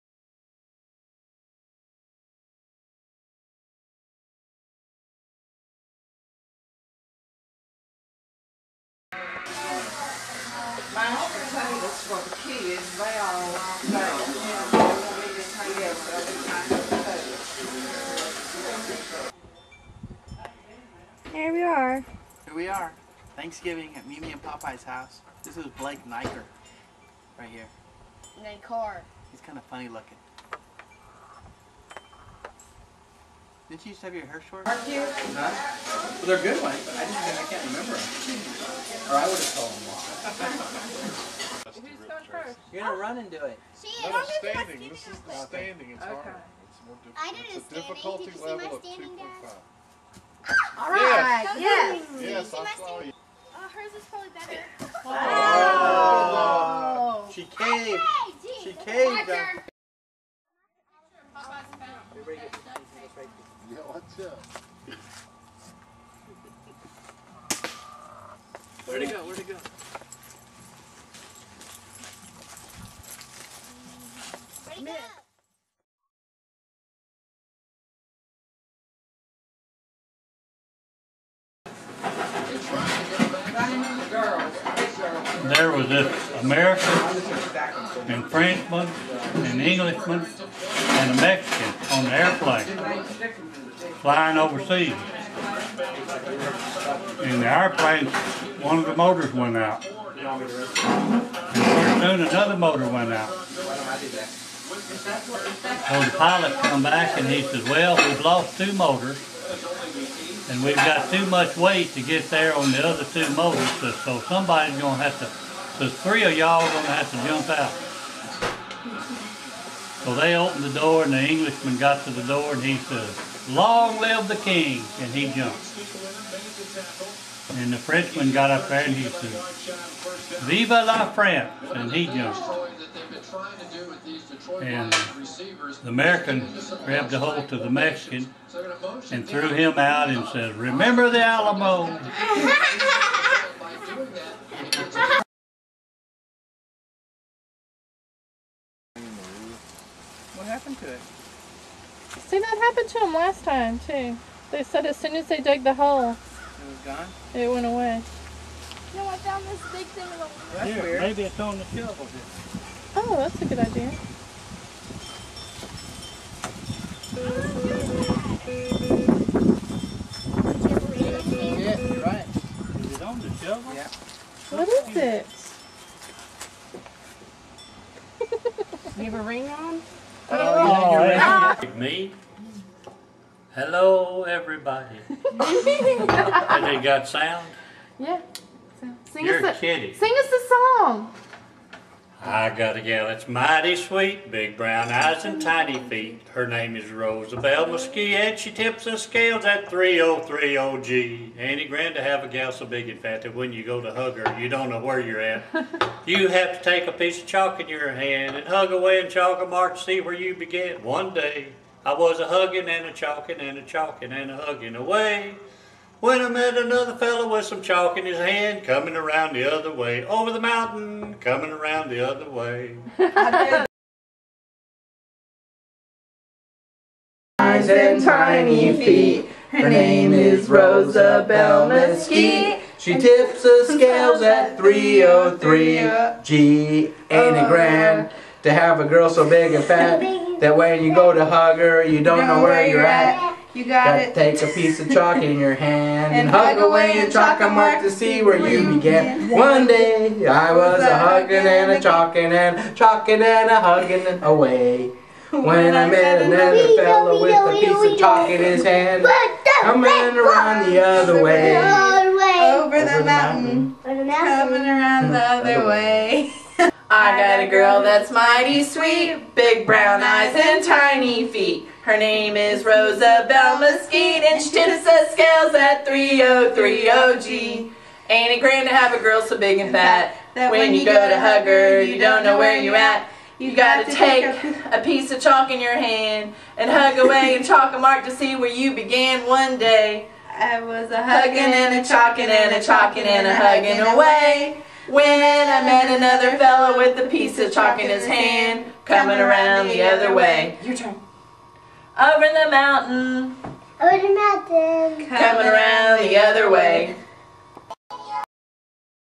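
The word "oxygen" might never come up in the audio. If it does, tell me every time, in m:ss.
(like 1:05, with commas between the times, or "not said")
not said.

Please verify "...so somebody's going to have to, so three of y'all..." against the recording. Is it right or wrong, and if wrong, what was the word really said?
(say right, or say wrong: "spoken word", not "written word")
right.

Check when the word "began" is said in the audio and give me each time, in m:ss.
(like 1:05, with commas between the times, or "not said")
3:30, 4:08, 4:48.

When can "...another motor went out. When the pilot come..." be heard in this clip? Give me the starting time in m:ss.
1:42.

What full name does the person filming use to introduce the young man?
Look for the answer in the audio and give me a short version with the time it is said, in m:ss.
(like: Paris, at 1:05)
Blake Niker, at 0:25.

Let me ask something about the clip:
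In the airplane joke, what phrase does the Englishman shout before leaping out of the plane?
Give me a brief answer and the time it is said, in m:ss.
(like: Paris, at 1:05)
Long live the king, at 2:03.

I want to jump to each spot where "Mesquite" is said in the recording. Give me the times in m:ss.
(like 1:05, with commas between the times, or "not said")
3:17, 3:51, 4:33.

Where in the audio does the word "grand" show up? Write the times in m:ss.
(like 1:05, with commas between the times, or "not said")
3:21, 3:57, 4:38.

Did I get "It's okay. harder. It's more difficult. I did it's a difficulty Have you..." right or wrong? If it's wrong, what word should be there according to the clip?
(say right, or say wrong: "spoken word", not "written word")
wrong: "Did", not "Have".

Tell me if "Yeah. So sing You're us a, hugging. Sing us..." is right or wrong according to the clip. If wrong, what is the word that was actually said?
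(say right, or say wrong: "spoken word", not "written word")
wrong: "kidding", not "hugging".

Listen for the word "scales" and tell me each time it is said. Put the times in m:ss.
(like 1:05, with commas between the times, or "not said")
3:18, 3:53, 4:35.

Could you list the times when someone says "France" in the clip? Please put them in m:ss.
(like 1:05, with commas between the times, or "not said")
2:11.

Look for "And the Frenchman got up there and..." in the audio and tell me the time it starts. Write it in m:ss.
2:07.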